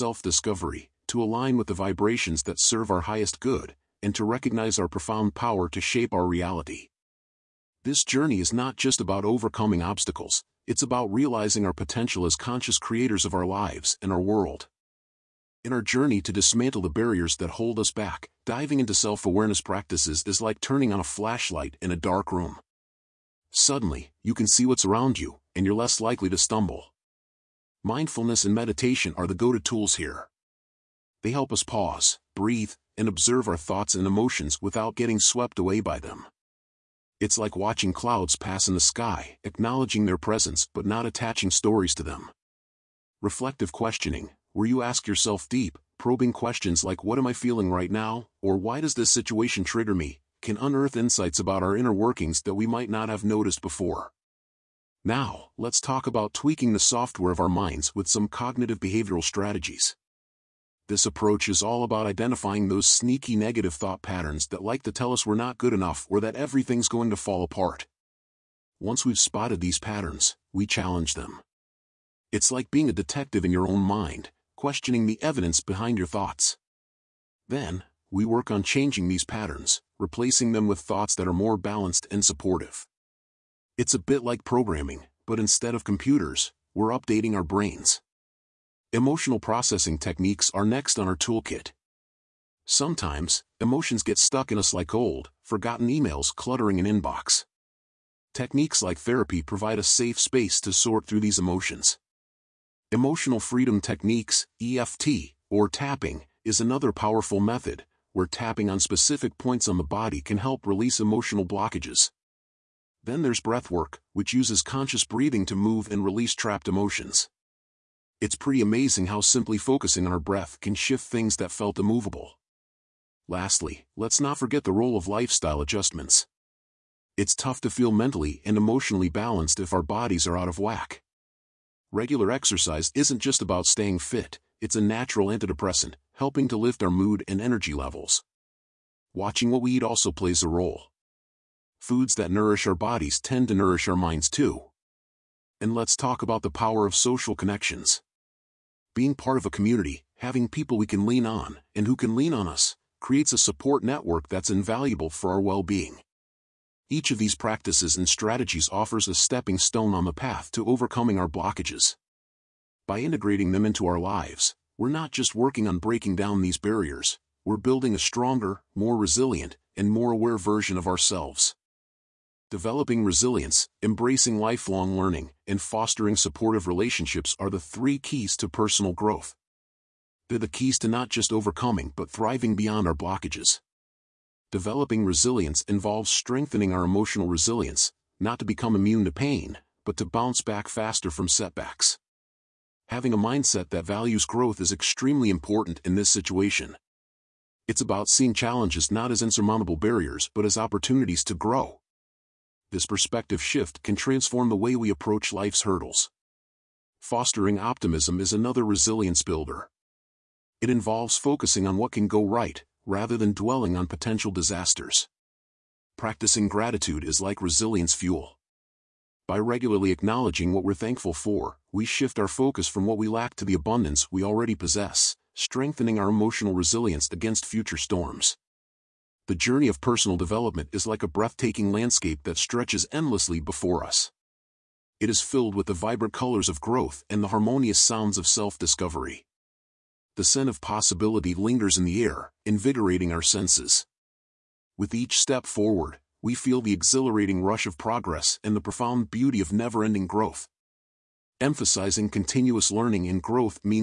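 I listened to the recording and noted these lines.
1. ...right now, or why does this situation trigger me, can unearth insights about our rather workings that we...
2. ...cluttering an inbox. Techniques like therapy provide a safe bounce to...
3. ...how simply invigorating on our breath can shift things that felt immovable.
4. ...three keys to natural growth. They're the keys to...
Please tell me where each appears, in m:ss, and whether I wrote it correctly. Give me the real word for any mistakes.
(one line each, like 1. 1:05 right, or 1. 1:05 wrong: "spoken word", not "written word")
1. 0:47 wrong: "inner", not "rather"
2. 1:36 wrong: "space", not "bounce"
3. 1:59 wrong: "focusing", not "invigorating"
4. 2:57 wrong: "personal", not "natural".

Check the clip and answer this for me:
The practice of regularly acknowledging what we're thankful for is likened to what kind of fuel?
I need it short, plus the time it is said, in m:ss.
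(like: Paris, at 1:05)
Resilience fuel, at 3:37.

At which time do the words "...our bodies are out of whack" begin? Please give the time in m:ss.
2:09.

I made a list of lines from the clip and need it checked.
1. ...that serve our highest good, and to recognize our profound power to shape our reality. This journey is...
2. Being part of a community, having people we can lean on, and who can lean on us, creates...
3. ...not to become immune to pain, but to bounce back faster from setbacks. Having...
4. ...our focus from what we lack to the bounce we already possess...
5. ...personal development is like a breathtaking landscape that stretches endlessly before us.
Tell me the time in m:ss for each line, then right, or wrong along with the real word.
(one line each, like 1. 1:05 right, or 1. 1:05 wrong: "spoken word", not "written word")
1. 0:02 right
2. 2:28 right
3. 3:08 right
4. 3:42 wrong: "abundance", not "bounce"
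5. 3:49 right.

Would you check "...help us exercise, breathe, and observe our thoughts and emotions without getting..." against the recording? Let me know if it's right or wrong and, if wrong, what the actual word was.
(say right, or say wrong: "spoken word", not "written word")
wrong: "pause", not "exercise".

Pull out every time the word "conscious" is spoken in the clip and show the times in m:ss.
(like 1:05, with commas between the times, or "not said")
0:12, 1:54.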